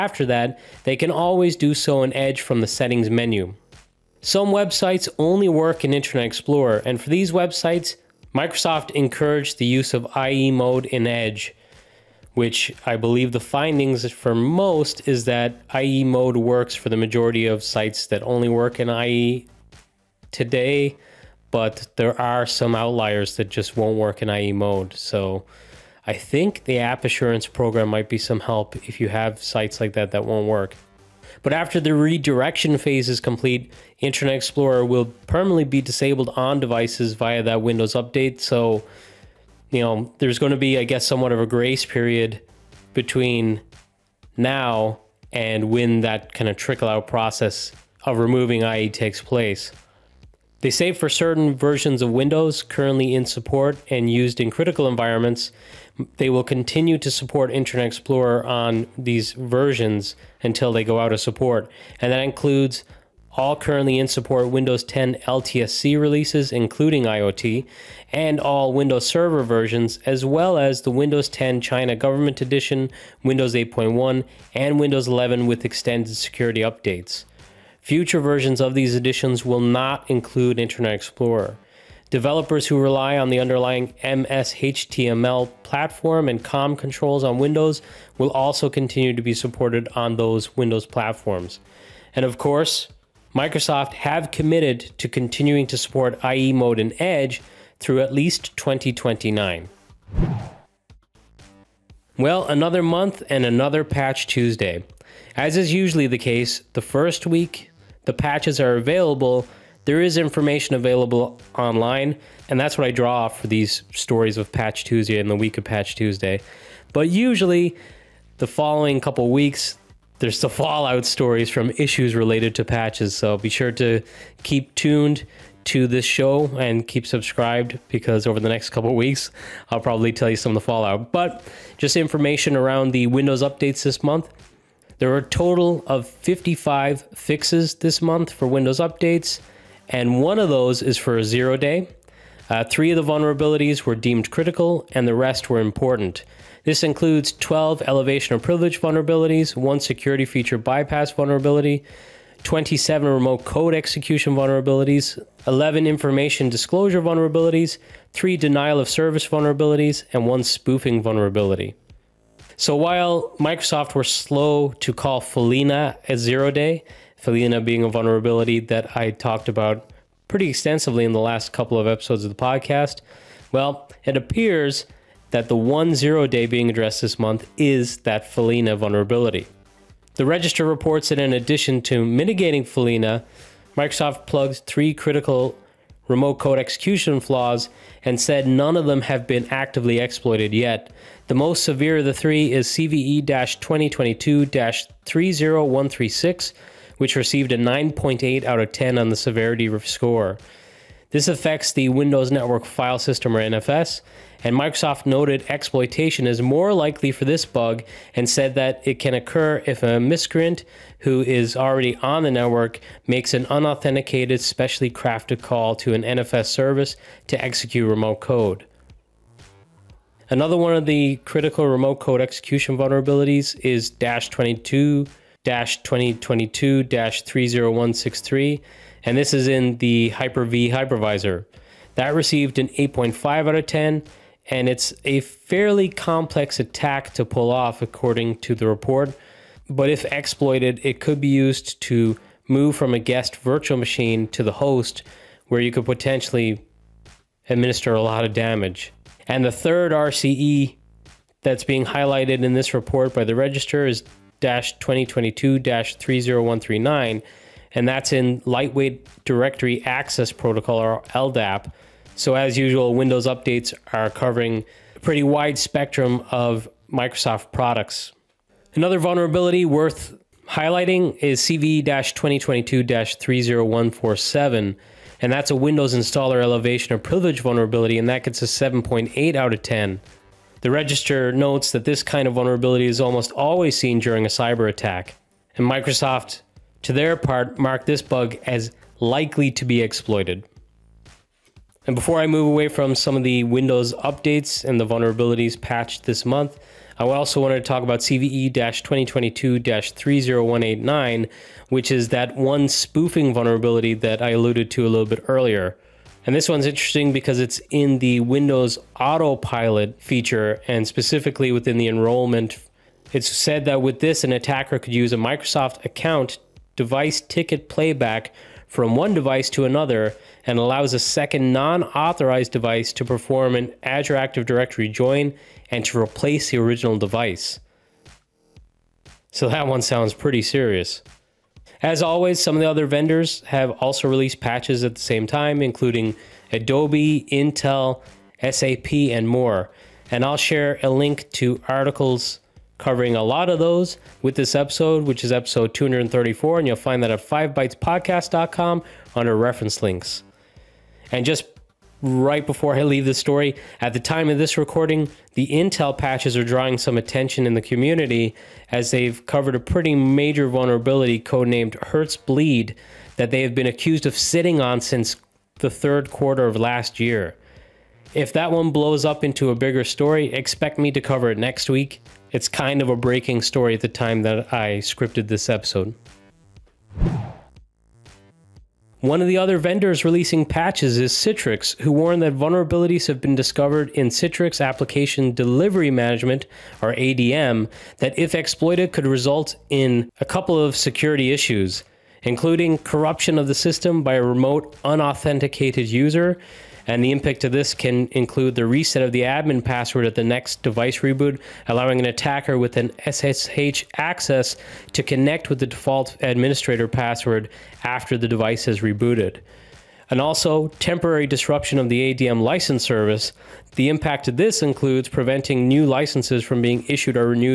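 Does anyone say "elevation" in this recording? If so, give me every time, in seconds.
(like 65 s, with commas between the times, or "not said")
147 s, 276 s.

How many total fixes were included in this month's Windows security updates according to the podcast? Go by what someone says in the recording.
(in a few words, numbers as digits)
55.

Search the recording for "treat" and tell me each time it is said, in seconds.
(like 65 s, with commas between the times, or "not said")
not said.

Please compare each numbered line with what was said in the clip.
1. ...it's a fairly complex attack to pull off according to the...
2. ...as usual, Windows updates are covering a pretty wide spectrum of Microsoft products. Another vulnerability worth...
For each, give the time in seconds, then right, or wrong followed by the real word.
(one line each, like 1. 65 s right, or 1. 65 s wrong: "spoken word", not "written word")
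1. 234 s right
2. 262 s right.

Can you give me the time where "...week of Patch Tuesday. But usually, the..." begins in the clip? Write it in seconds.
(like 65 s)
115 s.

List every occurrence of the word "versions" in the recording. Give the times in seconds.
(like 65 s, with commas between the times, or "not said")
51 s, 59 s, 69 s, 78 s.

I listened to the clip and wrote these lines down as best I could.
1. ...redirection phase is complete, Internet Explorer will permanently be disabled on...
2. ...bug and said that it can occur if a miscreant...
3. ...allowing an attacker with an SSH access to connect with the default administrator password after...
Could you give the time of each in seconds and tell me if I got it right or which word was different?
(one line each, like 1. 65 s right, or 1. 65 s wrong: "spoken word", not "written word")
1. 31 s right
2. 207 s right
3. 401 s right.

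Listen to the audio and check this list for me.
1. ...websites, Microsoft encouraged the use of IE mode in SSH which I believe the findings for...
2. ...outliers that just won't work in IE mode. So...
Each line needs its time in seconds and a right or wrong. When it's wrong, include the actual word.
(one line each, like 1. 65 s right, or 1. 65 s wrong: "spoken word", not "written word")
1. 7 s wrong: "Edge", not "SSH"
2. 22 s right.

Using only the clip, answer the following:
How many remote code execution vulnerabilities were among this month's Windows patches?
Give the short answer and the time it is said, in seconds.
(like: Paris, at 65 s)
27, at 152 s.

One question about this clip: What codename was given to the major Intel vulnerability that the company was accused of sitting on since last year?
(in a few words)
Hertzbleed.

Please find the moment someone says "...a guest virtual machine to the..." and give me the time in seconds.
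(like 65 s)
242 s.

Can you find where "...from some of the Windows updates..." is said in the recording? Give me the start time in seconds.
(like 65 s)
292 s.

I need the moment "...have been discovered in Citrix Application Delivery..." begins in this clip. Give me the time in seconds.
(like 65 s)
383 s.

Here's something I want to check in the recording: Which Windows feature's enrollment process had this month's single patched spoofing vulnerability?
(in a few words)
Windows Autopilot.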